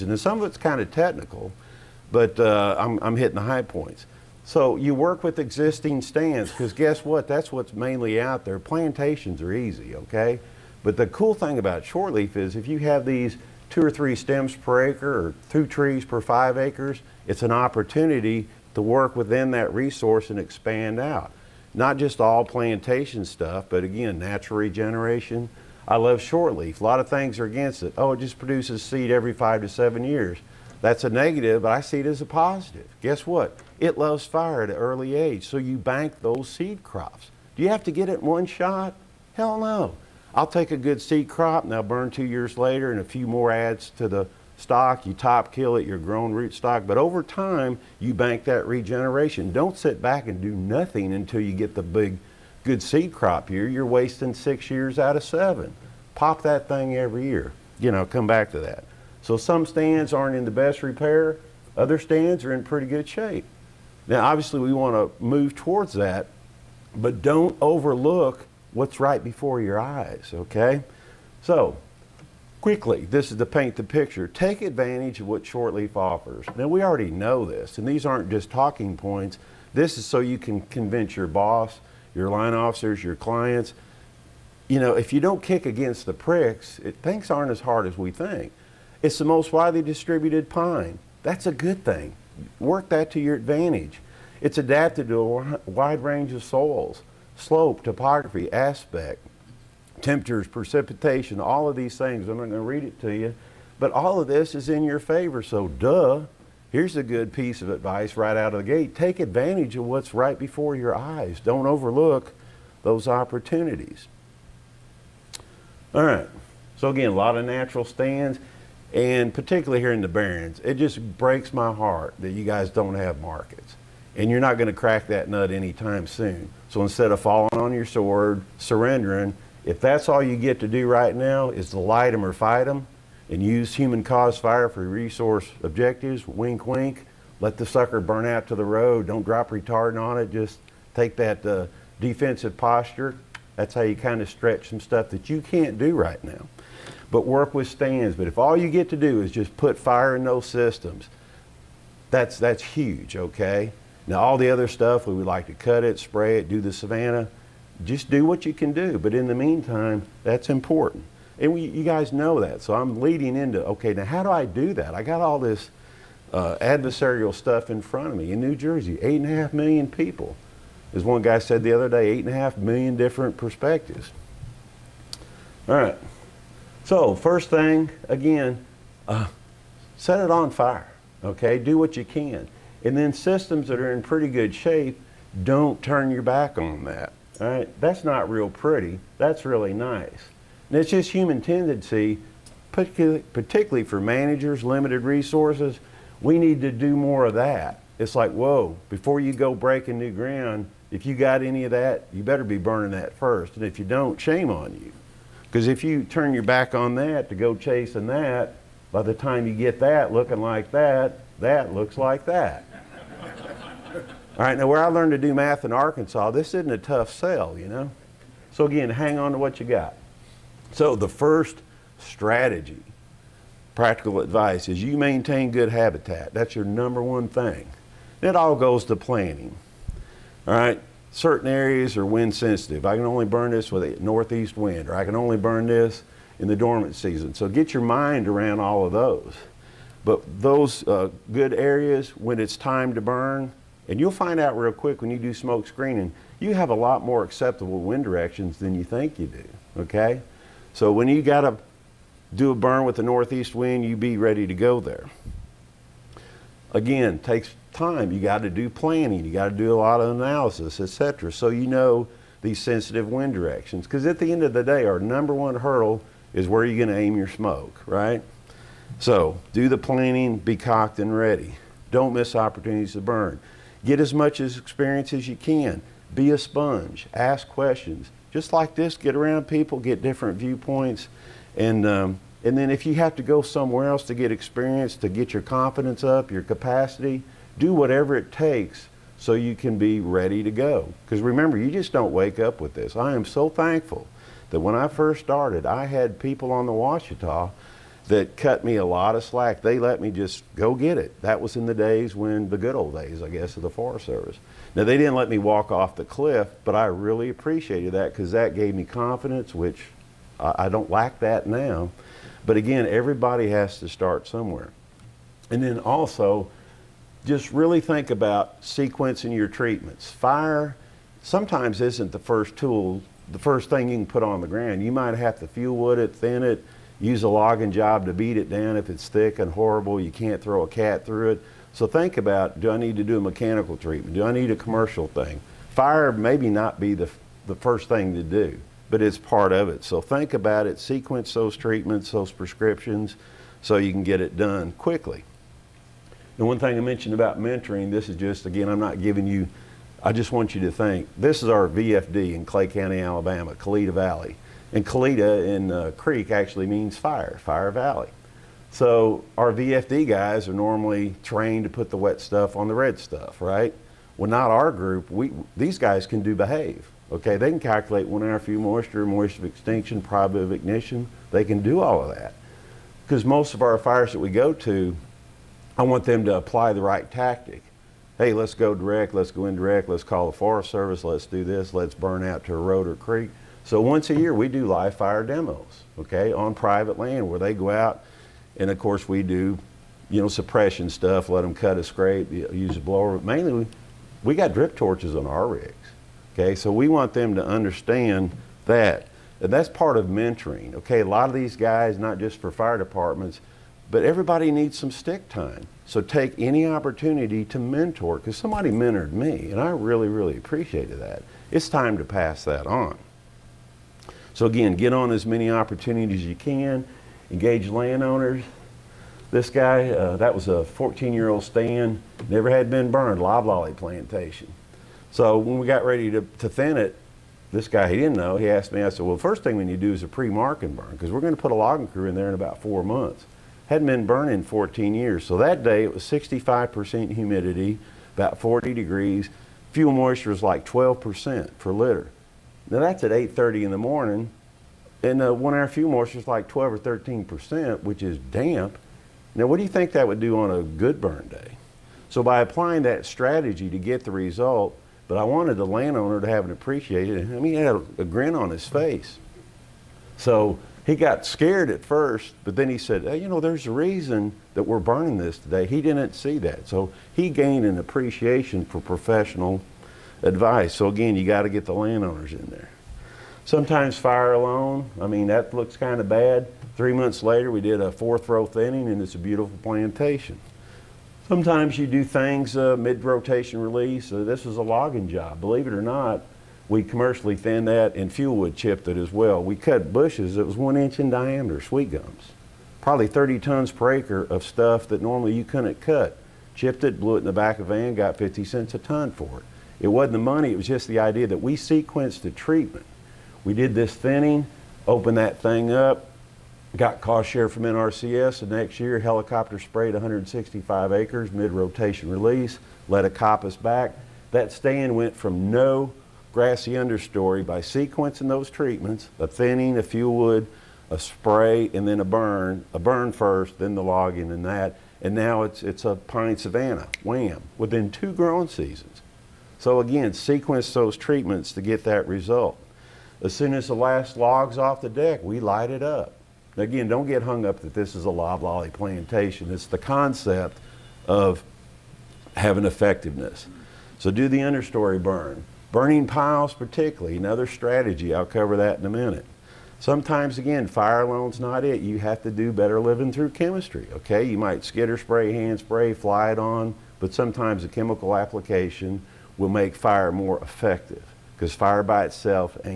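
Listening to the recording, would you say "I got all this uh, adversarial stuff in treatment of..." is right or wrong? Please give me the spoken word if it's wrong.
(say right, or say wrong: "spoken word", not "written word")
wrong: "front", not "treatment".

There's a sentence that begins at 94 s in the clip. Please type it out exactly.
It's adapted to a wide range of soils, slope, topography, aspect temperatures, precipitation, all of these things.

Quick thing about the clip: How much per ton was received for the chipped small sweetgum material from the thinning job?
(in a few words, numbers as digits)
50 cents.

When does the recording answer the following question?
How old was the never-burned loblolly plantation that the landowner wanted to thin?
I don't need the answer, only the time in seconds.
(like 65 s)
420 s.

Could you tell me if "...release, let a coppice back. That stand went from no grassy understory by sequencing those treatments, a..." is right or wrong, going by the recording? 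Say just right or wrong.
right.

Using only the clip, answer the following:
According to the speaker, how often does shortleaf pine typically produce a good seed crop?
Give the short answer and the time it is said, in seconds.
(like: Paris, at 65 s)
every 5 to 7 years, at 29 s.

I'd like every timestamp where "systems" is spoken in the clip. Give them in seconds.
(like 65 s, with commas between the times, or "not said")
150 s, 183 s.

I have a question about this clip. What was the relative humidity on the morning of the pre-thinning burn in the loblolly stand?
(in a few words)
65%.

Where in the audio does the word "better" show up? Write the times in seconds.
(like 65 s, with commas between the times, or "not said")
202 s, 552 s.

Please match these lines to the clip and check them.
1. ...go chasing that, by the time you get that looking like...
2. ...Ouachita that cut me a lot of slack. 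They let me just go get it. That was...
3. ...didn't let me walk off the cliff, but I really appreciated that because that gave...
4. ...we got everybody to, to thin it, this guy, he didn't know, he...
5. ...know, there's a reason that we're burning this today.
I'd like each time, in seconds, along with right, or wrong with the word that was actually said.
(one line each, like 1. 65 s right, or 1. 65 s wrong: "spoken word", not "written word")
1. 207 s right
2. 296 s right
3. 304 s right
4. 425 s wrong: "ready", not "everybody"
5. 463 s right.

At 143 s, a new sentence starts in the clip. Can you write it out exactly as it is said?
That's how you kind of stretch some stuff that you can't do right now.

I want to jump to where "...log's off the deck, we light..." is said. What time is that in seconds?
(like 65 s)
534 s.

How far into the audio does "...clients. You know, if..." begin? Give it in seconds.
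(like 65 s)
83 s.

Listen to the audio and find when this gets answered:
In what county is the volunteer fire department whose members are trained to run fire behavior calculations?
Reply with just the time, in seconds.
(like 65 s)
352 s.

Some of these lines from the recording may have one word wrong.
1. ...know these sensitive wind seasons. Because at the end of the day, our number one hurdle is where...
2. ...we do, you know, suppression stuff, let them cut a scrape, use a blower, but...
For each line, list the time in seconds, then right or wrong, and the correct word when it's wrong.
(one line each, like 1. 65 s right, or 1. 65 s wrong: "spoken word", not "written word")
1. 261 s wrong: "directions", not "seasons"
2. 389 s right.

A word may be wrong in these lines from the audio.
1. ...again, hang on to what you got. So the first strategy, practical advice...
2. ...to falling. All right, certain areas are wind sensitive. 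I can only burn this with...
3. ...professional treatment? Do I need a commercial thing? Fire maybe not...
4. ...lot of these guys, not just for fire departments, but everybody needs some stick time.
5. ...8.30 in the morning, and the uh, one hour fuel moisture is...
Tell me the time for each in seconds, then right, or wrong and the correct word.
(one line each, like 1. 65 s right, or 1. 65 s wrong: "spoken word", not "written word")
1. 218 s right
2. 228 s wrong: "planning", not "falling"
3. 333 s wrong: "mechanical", not "professional"
4. 401 s right
5. 443 s right.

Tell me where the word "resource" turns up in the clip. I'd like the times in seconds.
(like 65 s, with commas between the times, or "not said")
19 s, 134 s, 195 s.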